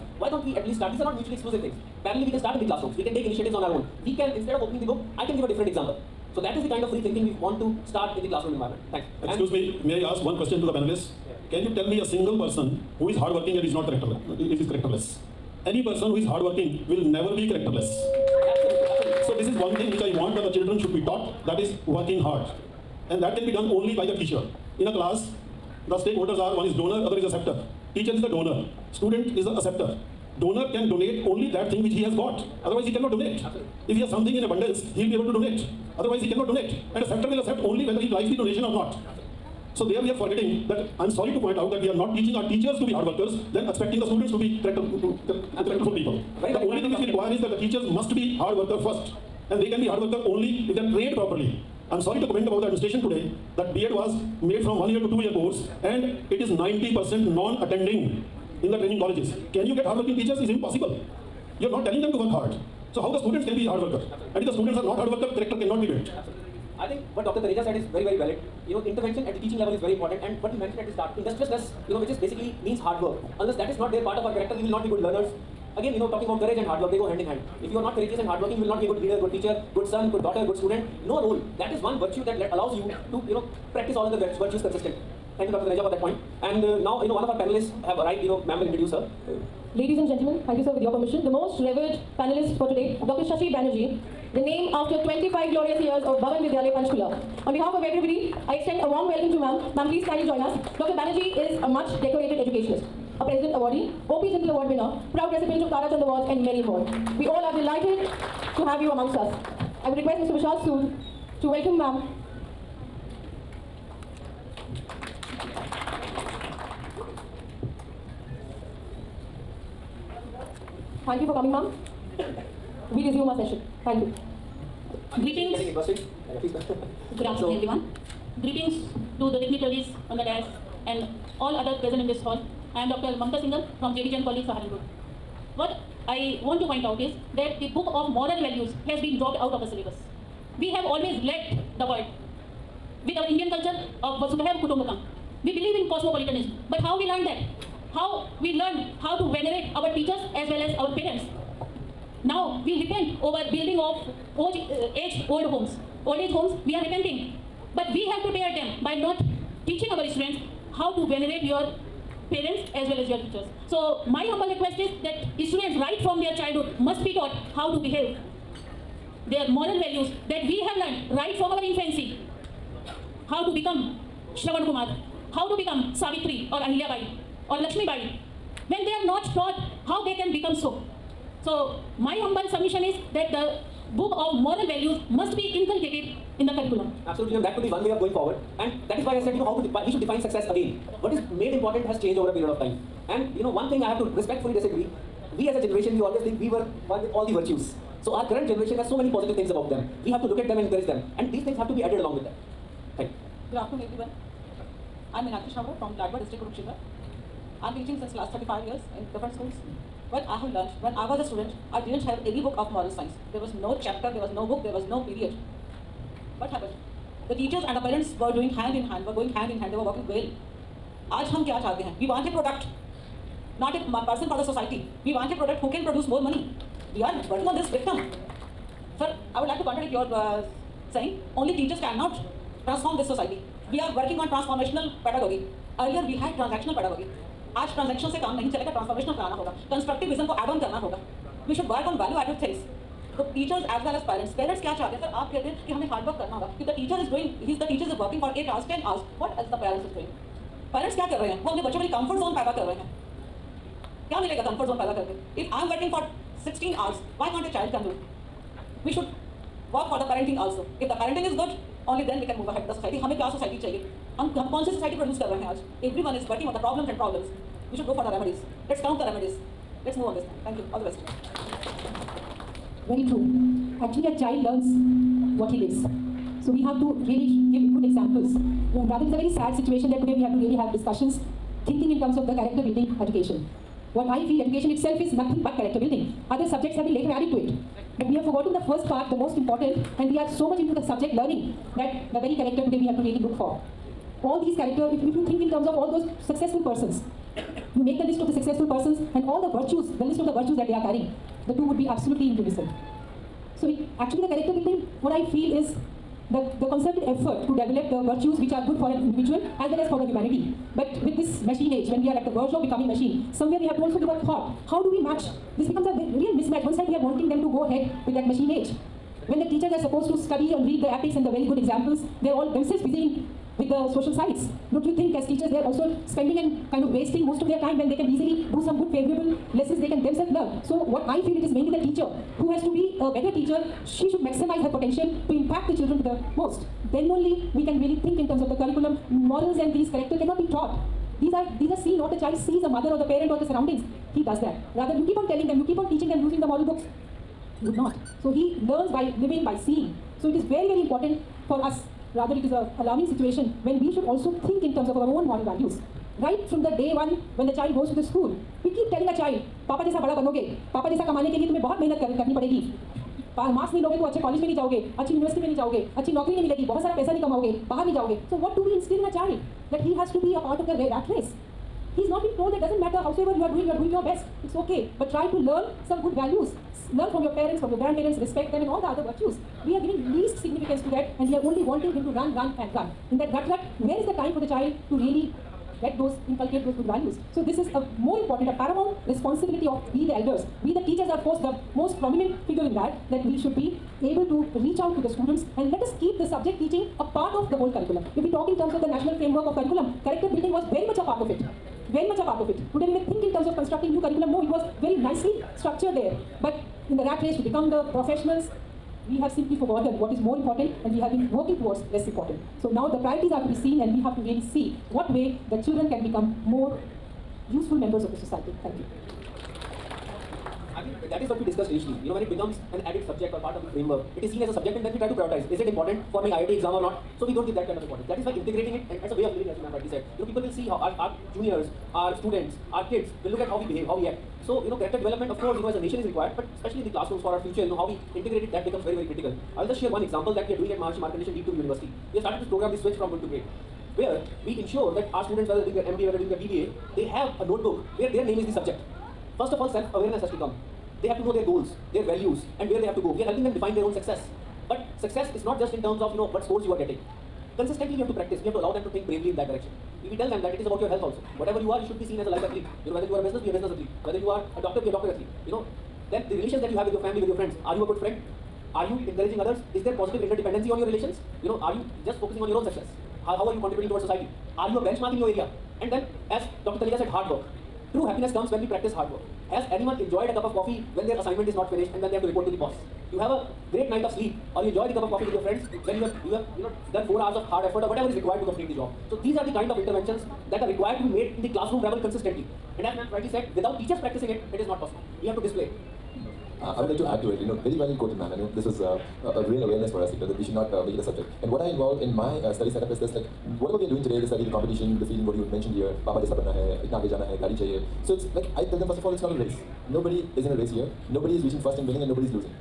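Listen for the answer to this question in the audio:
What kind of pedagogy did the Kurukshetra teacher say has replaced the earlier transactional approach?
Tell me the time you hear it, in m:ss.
3:54.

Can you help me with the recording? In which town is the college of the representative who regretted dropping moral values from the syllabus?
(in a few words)
Saharanpur.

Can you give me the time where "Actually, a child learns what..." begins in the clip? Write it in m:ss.
4:33.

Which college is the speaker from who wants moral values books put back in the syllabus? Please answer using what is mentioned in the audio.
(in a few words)
JV Jain College.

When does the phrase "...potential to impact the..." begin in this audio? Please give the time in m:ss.
5:34.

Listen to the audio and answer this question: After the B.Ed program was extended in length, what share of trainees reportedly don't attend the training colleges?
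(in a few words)
90%.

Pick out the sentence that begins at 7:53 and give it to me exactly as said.
How, how are you contributing towards society?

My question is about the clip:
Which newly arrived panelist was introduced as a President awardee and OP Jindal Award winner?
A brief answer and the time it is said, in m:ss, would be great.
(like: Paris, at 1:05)
Dr. Shashi Banerjee, at 1:33.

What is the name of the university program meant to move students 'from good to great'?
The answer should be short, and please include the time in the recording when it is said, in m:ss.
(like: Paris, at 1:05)
switch from good to great, at 7:22.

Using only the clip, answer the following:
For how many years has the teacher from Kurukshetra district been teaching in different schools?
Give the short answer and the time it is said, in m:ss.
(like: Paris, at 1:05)
35, at 3:28.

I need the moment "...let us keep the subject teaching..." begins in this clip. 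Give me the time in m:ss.
6:35.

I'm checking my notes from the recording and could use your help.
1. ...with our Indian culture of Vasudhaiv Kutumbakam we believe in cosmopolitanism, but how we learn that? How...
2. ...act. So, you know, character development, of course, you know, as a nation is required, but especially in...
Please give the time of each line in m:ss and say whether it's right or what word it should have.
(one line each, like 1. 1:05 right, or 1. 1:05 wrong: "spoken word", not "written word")
1. 2:23 right
2. 7:14 right.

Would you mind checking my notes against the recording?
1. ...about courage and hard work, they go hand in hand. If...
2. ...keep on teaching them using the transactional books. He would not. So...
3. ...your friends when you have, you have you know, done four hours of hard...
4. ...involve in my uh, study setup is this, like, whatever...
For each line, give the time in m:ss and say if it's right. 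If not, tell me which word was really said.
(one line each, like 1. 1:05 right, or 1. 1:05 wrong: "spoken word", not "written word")
1. 1:16 right
2. 5:45 wrong: "moral", not "transactional"
3. 8:05 right
4. 8:21 right.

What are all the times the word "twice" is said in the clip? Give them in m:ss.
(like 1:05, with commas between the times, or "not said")
not said.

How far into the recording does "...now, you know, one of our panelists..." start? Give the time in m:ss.
1:26.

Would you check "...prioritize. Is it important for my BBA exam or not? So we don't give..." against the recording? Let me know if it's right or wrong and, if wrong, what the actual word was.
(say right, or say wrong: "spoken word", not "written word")
wrong: "IIT", not "BBA".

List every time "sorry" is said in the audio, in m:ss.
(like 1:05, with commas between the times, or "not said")
0:41, 0:52.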